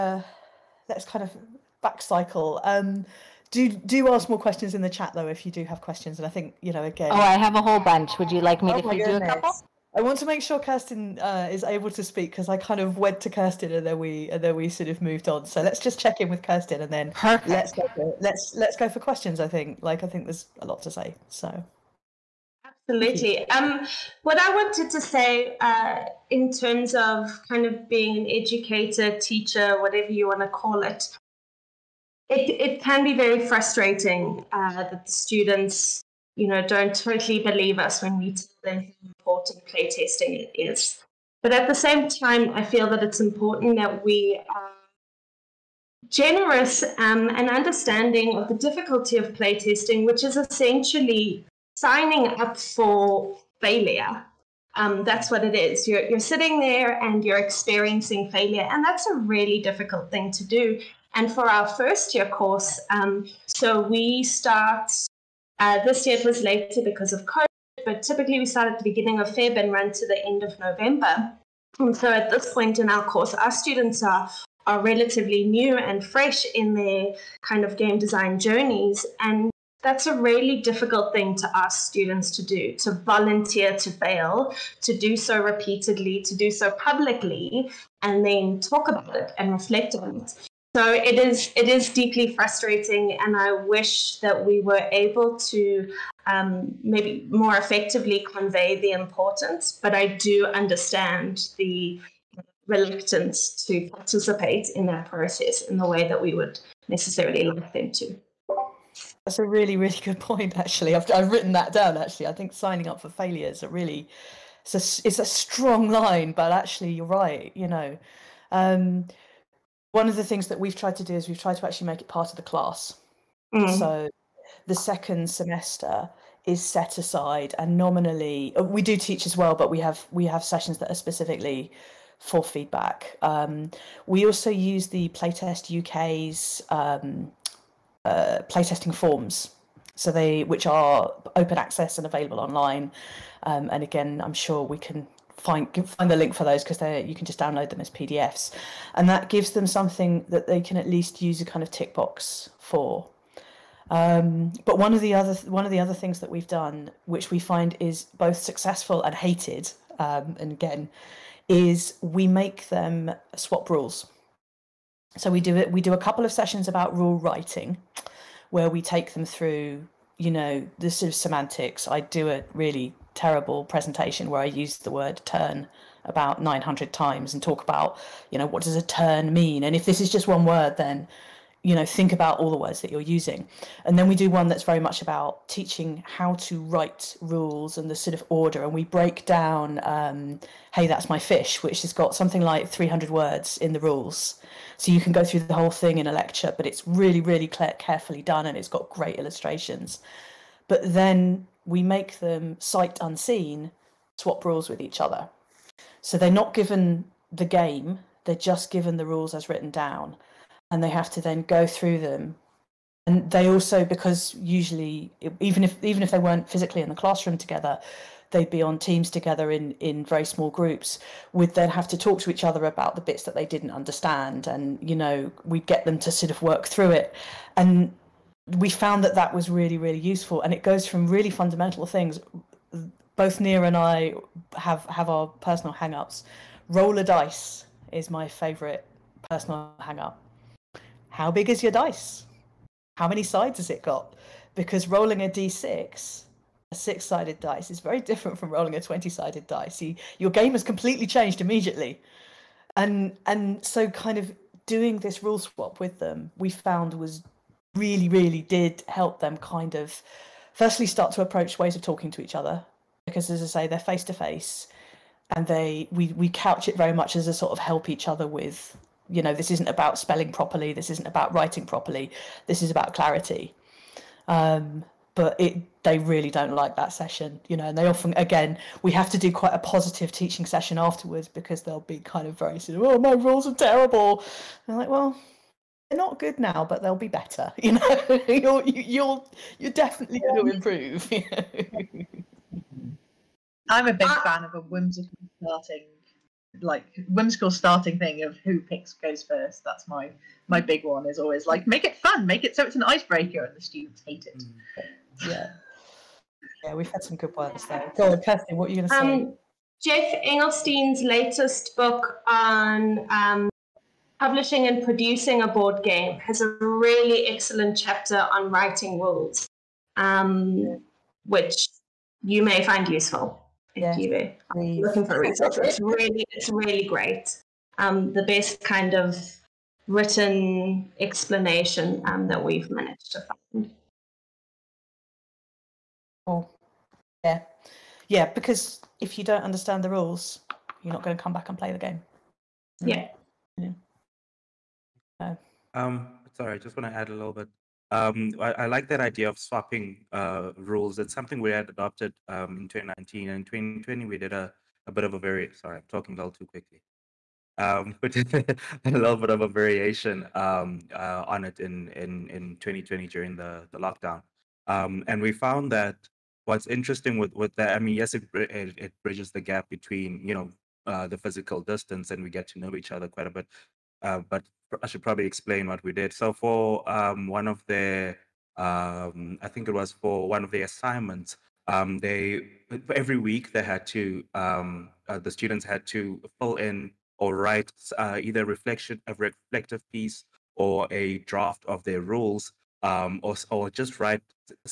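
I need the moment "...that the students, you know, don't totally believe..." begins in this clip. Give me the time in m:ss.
0:34.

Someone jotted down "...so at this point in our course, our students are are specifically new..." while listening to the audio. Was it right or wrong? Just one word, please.
wrong.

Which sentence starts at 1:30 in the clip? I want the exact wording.
So it is it is deeply frustrating, and I wish that we were able to um, maybe more effectively convey the importance.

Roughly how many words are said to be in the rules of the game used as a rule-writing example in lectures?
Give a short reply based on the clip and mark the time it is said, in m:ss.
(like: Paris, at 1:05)
300, at 3:12.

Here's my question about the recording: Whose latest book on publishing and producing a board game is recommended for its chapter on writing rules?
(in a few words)
Geoff Engelstein.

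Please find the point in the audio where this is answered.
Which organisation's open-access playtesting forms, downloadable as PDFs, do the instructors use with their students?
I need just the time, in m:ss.
2:15.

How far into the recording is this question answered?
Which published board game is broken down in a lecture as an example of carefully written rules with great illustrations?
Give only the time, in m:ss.
3:10.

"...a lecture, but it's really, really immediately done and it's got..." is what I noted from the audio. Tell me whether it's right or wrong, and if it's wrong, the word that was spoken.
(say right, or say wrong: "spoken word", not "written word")
wrong: "carefully", not "immediately".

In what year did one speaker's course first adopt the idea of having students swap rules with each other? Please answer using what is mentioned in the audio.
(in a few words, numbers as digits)
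2019.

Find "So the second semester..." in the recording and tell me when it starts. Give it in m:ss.
2:03.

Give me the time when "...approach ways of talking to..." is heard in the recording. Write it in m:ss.
4:21.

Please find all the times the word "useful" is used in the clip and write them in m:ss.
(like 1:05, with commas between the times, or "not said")
3:49, 5:22.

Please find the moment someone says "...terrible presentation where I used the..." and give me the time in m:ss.
2:53.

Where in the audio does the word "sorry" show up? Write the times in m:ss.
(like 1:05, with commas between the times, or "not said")
5:46, 5:55.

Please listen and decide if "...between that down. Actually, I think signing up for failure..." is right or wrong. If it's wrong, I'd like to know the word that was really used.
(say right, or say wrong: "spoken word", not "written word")
wrong: "written", not "between".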